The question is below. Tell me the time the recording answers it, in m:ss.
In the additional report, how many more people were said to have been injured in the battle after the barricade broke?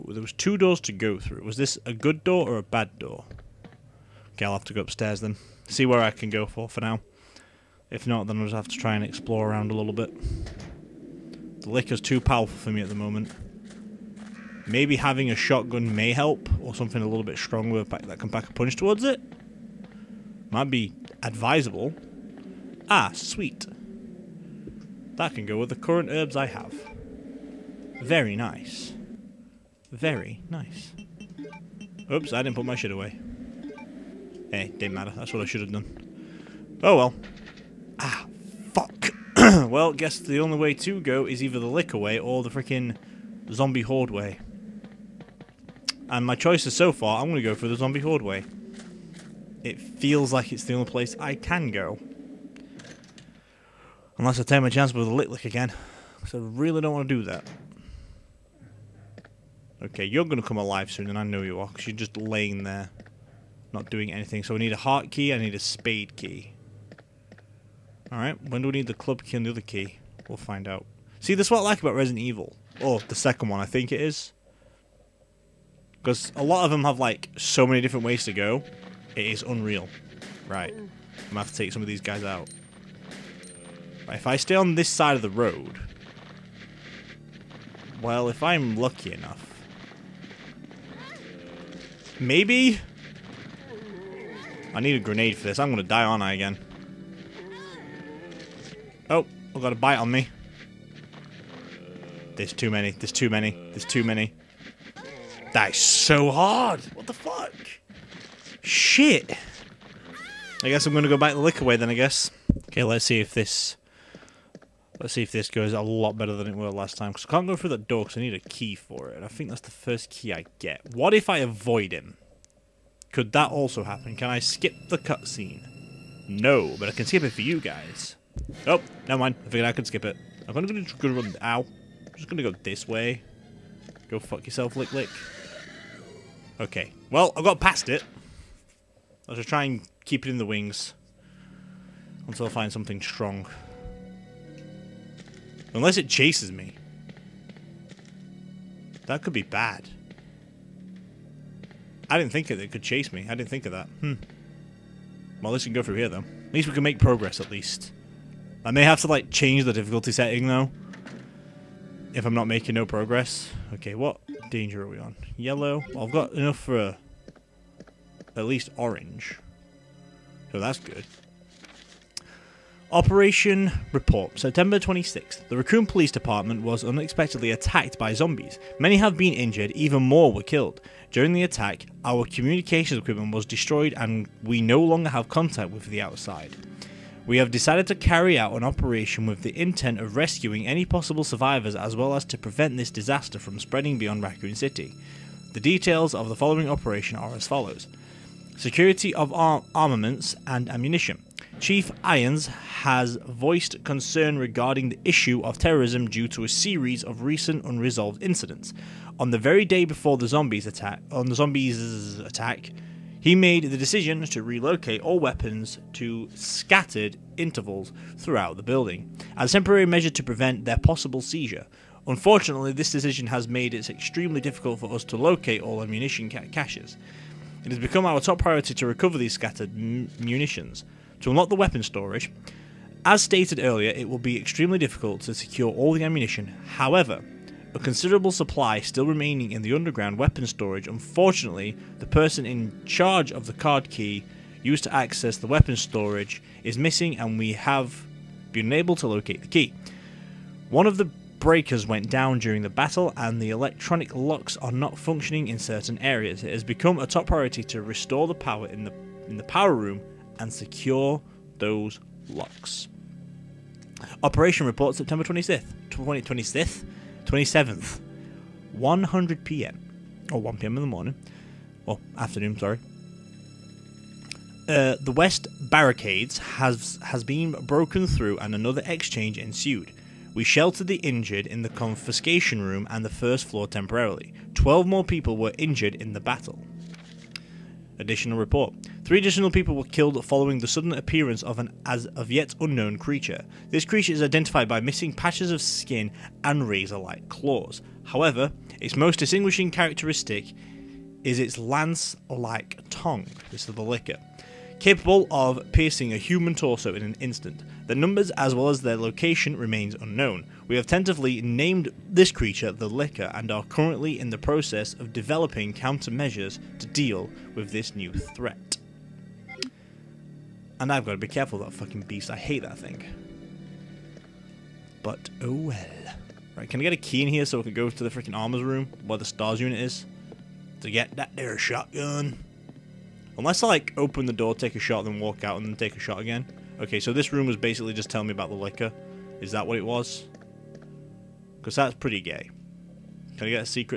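4:44.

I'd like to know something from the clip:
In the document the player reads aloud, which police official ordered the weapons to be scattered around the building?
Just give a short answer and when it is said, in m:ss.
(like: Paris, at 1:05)
Chief Irons, at 3:21.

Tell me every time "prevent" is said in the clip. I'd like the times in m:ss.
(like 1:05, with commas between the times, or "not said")
3:12, 3:40.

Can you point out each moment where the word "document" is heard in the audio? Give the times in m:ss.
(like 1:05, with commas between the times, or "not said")
not said.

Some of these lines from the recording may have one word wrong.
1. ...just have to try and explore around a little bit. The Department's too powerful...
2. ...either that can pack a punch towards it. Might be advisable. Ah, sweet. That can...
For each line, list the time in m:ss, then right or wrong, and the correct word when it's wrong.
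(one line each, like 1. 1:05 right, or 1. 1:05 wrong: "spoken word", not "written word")
1. 0:08 wrong: "Licker", not "Department"
2. 0:17 wrong: "stronger", not "either".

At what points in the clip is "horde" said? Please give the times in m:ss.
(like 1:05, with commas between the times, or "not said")
0:43, 0:48.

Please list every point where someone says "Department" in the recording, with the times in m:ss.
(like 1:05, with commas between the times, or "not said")
2:56.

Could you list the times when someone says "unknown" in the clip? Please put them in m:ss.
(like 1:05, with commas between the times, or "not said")
4:52, 5:09.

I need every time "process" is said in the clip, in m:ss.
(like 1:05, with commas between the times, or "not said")
5:14.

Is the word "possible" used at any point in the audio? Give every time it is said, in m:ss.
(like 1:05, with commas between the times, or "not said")
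3:10, 3:40.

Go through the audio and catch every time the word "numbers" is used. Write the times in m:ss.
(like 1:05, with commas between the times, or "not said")
5:07.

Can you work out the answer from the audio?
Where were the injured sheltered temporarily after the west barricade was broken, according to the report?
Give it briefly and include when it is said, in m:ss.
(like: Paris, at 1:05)
Confiscation room, at 4:41.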